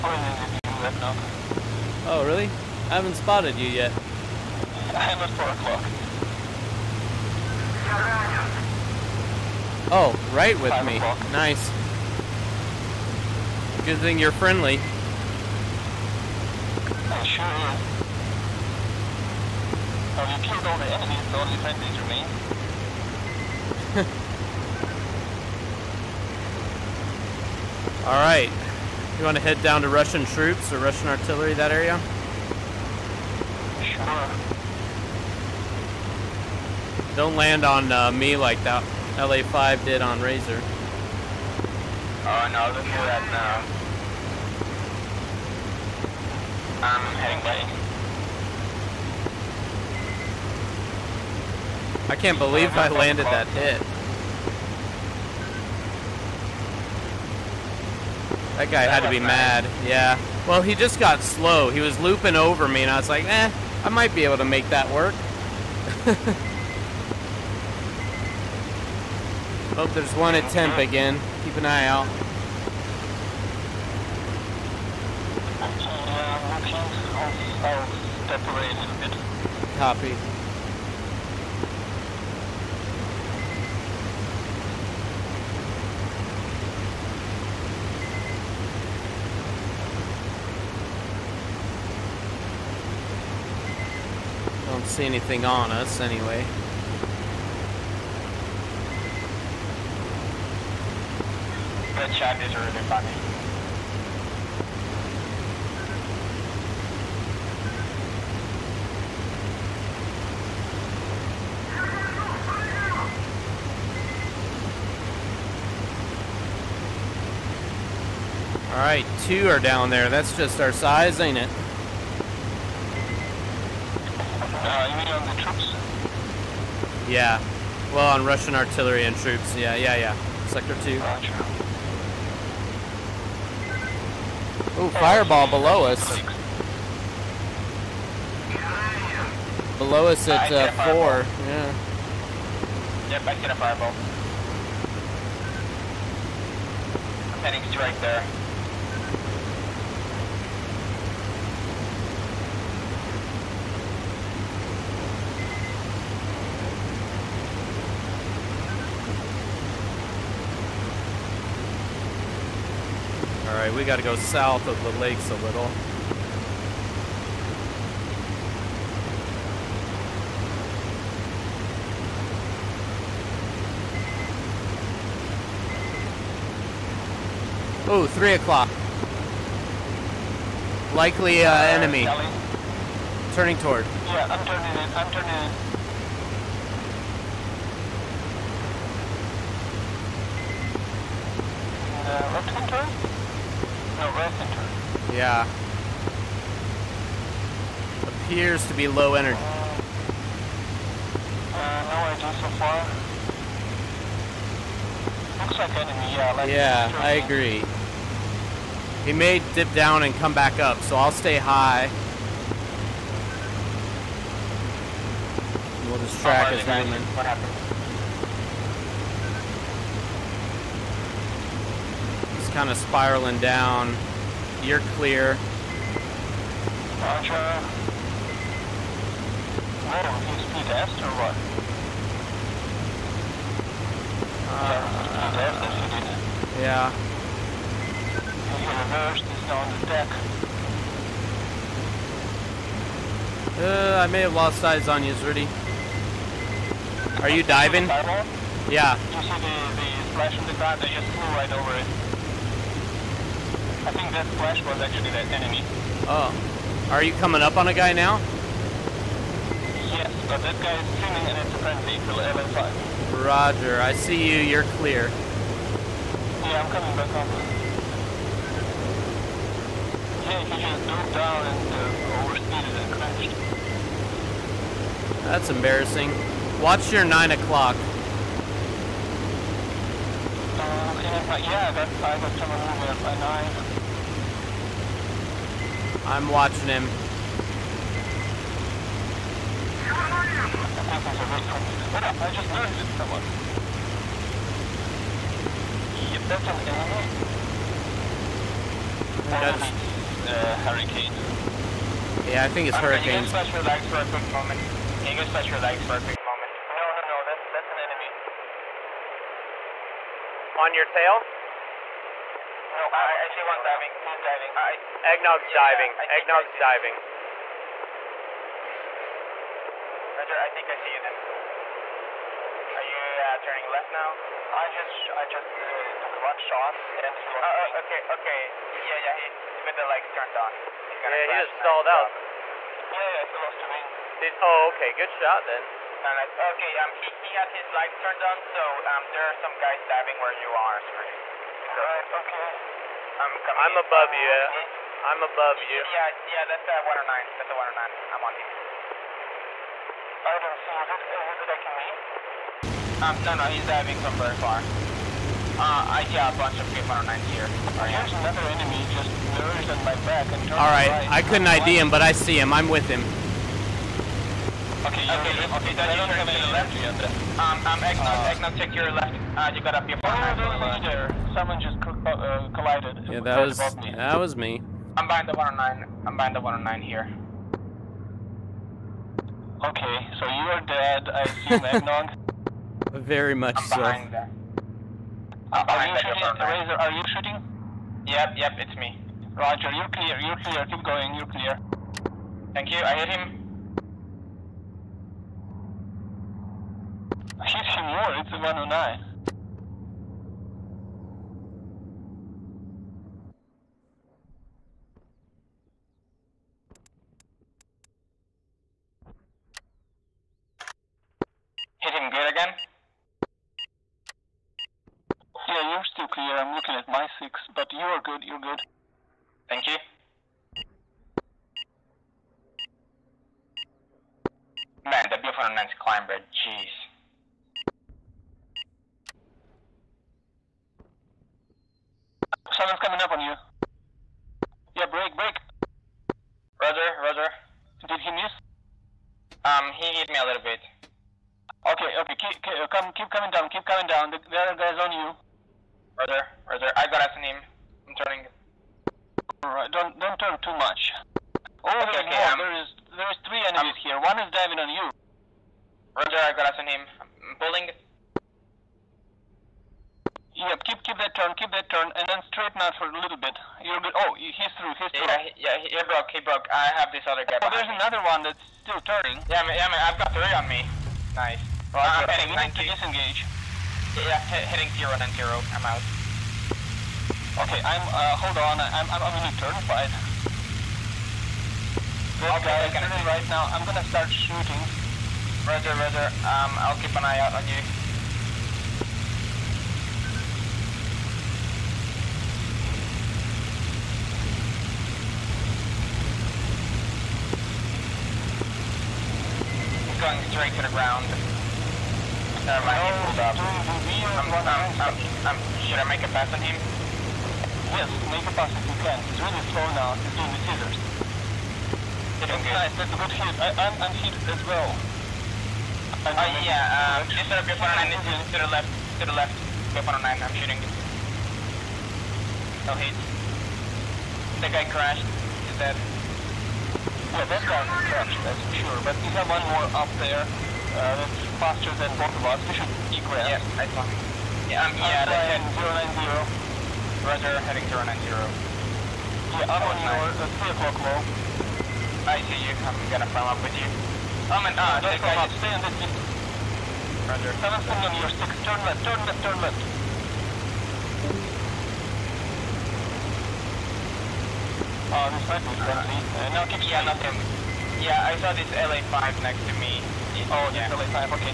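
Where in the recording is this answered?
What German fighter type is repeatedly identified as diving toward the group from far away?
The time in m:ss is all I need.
5:46.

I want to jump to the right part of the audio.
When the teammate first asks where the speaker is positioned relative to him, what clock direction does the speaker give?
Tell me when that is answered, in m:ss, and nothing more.
0:04.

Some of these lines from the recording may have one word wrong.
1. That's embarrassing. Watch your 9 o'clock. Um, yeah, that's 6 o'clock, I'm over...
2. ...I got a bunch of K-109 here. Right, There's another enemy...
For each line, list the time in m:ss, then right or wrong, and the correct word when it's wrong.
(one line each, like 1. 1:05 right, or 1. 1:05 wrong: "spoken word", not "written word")
1. 4:35 wrong: "5", not "6"
2. 5:56 right.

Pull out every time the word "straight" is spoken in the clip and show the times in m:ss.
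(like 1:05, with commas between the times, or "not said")
2:27, 8:20.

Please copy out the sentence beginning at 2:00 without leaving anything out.
That's just our size, ain't it?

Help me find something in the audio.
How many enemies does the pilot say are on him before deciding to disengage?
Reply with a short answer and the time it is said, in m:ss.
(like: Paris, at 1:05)
3, at 7:49.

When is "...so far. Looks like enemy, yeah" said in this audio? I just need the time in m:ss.
3:22.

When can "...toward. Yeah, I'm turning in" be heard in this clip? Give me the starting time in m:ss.
3:03.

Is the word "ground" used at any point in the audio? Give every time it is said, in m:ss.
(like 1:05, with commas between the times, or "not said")
4:10, 8:20.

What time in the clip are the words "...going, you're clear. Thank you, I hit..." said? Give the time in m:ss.
6:30.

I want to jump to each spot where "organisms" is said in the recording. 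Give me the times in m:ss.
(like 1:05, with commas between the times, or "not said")
not said.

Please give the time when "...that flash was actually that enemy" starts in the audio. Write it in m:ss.
4:14.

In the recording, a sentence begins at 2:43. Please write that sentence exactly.
Alright, we gotta go south of the lakes a little.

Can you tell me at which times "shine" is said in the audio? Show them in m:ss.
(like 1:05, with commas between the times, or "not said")
not said.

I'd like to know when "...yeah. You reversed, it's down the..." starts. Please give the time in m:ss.
3:56.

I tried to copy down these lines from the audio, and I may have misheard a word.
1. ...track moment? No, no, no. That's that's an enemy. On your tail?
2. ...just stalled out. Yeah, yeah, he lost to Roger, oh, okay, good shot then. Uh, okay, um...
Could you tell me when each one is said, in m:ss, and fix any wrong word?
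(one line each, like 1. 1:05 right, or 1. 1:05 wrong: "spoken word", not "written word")
1. 5:06 wrong: "quick", not "track"
2. 5:31 wrong: "Did", not "Roger".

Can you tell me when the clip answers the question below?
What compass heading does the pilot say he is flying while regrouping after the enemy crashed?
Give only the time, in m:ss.
8:55.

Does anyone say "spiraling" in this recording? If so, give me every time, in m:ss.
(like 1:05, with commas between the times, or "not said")
3:42.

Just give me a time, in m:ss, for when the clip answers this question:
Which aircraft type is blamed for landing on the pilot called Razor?
0:39.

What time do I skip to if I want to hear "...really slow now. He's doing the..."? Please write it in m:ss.
8:29.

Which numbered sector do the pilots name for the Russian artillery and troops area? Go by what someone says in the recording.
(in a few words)
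Sector two.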